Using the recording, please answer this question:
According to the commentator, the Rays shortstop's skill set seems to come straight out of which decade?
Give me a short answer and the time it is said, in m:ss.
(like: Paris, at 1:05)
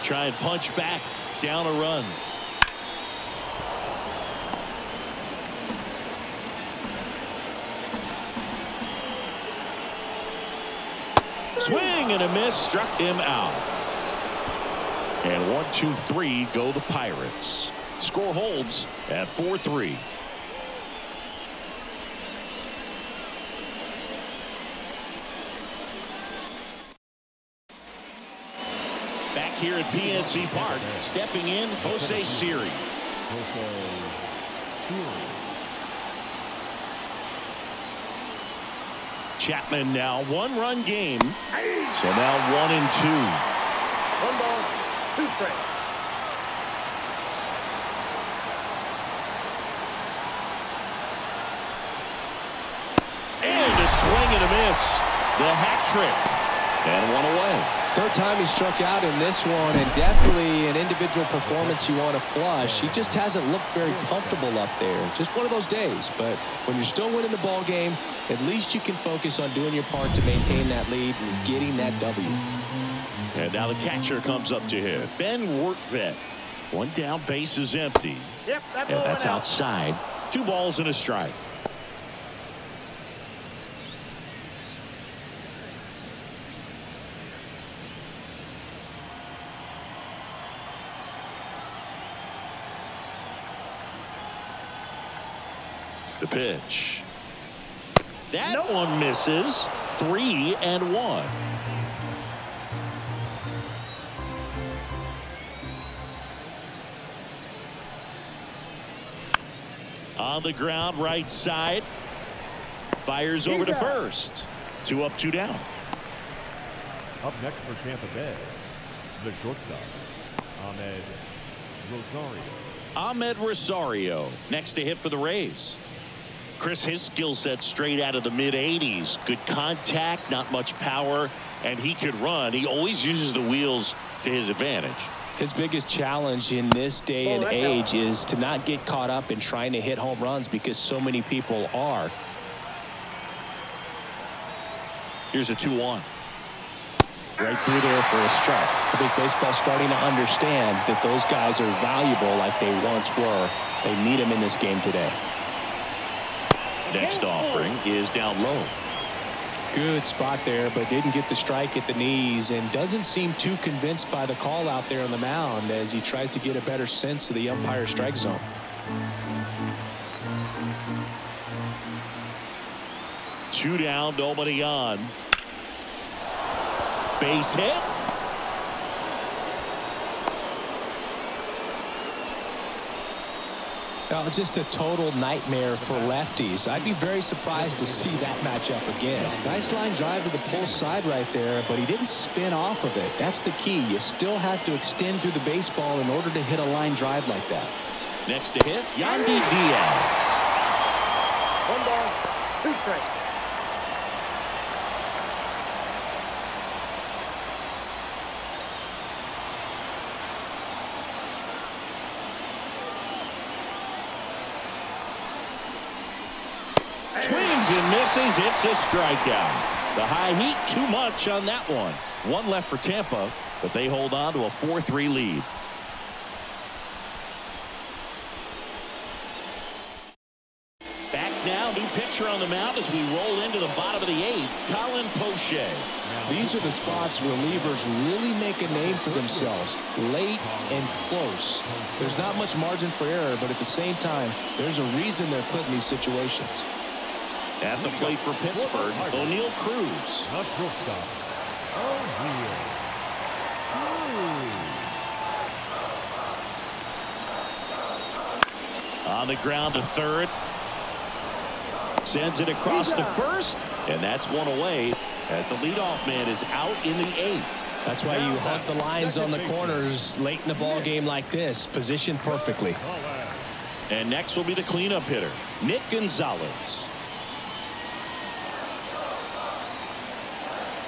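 mid 80s, at 2:08.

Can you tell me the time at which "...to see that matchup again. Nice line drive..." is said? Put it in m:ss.
3:07.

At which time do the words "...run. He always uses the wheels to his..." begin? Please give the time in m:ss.
2:12.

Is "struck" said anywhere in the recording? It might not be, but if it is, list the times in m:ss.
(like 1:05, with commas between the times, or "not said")
0:12, 0:58.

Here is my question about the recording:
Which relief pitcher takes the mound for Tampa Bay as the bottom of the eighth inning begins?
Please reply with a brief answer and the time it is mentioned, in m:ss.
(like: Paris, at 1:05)
Colin Poche, at 3:54.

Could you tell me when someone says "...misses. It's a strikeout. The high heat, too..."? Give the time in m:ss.
3:37.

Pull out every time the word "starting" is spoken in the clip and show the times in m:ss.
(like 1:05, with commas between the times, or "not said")
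2:29.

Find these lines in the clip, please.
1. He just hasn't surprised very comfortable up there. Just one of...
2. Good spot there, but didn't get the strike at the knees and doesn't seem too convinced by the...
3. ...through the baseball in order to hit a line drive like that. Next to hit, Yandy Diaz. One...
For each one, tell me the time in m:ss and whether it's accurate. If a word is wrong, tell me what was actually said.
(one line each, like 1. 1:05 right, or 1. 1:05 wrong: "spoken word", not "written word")
1. 1:02 wrong: "looked", not "surprised"
2. 2:39 right
3. 3:15 right.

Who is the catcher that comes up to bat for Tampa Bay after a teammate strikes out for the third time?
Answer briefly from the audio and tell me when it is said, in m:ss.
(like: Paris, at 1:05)
Ben Rortvedt, at 1:15.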